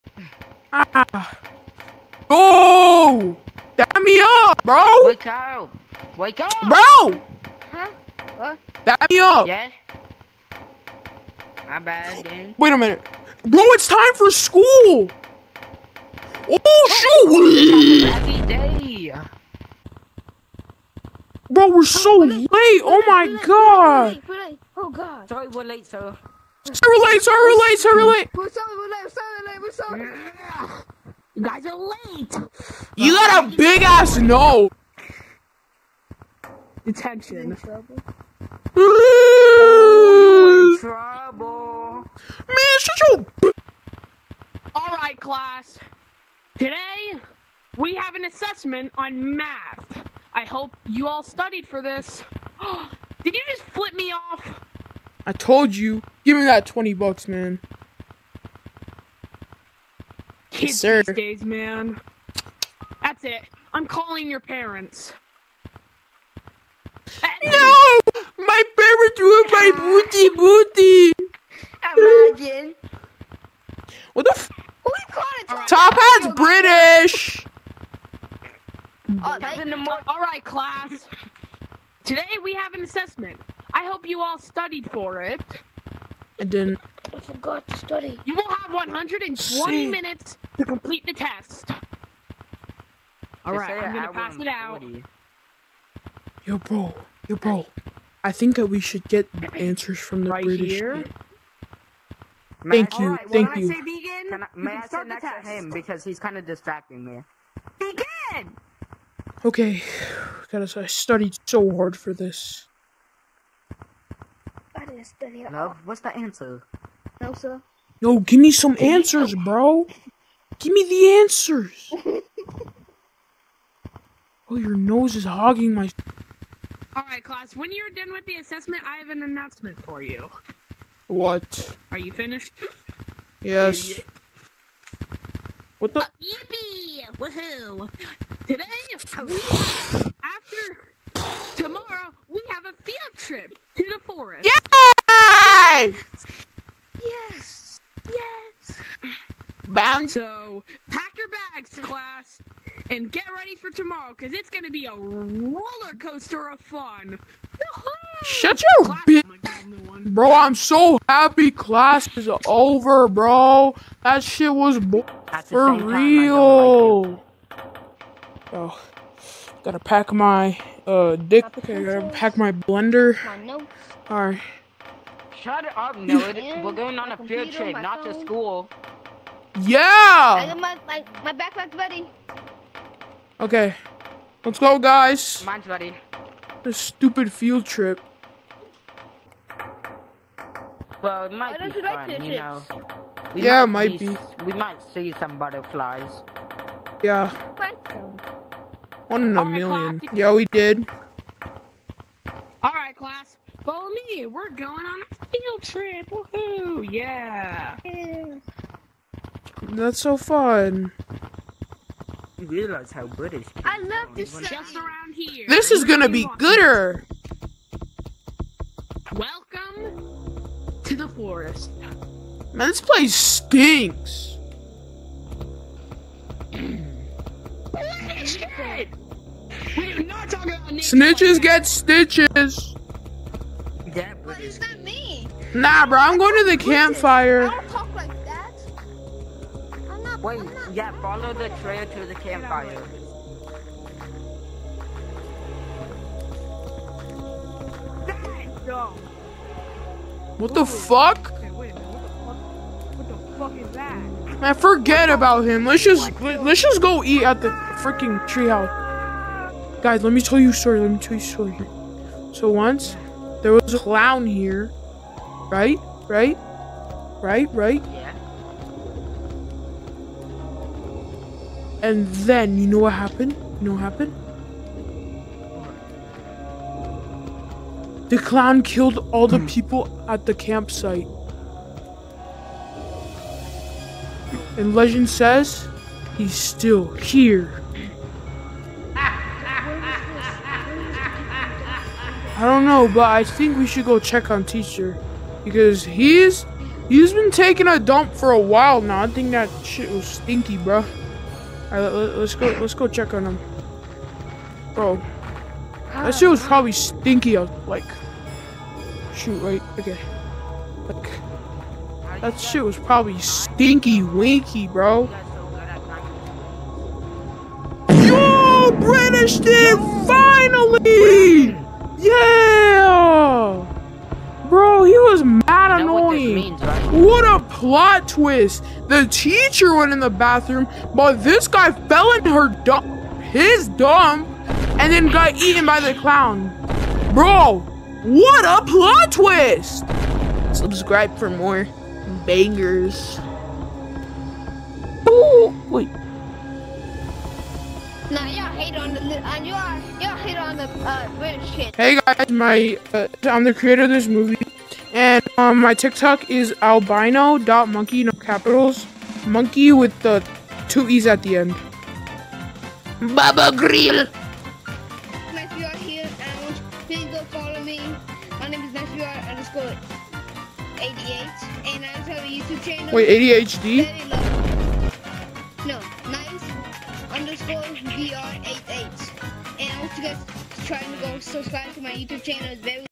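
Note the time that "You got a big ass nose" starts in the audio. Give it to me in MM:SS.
00:32.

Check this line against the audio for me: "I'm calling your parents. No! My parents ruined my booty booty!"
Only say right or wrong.
right.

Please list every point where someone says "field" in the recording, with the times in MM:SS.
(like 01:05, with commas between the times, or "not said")
02:22, 02:57, 03:07, 03:25.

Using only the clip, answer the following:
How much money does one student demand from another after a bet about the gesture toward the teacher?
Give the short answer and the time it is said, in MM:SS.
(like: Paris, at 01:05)
20 bucks, at 00:56.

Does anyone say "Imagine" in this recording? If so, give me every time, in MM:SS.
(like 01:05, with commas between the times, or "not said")
01:11.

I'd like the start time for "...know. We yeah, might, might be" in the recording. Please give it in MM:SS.
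03:12.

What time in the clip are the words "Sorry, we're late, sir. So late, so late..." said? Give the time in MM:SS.
00:25.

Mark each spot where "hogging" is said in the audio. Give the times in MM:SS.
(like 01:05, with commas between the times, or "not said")
02:05.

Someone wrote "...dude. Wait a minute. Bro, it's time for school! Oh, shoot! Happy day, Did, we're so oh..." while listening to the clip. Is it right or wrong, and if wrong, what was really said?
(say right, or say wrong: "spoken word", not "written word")
wrong: "Bro", not "Did".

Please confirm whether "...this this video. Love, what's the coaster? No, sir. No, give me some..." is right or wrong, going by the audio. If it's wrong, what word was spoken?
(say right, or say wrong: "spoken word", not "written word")
wrong: "answer", not "coaster".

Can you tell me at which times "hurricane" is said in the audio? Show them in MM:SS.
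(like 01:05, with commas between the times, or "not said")
not said.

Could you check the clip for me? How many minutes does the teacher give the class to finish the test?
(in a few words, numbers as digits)
120.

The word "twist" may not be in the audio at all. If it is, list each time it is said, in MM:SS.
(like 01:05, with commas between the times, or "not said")
05:28, 05:39.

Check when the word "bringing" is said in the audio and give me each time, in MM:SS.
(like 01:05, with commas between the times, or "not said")
not said.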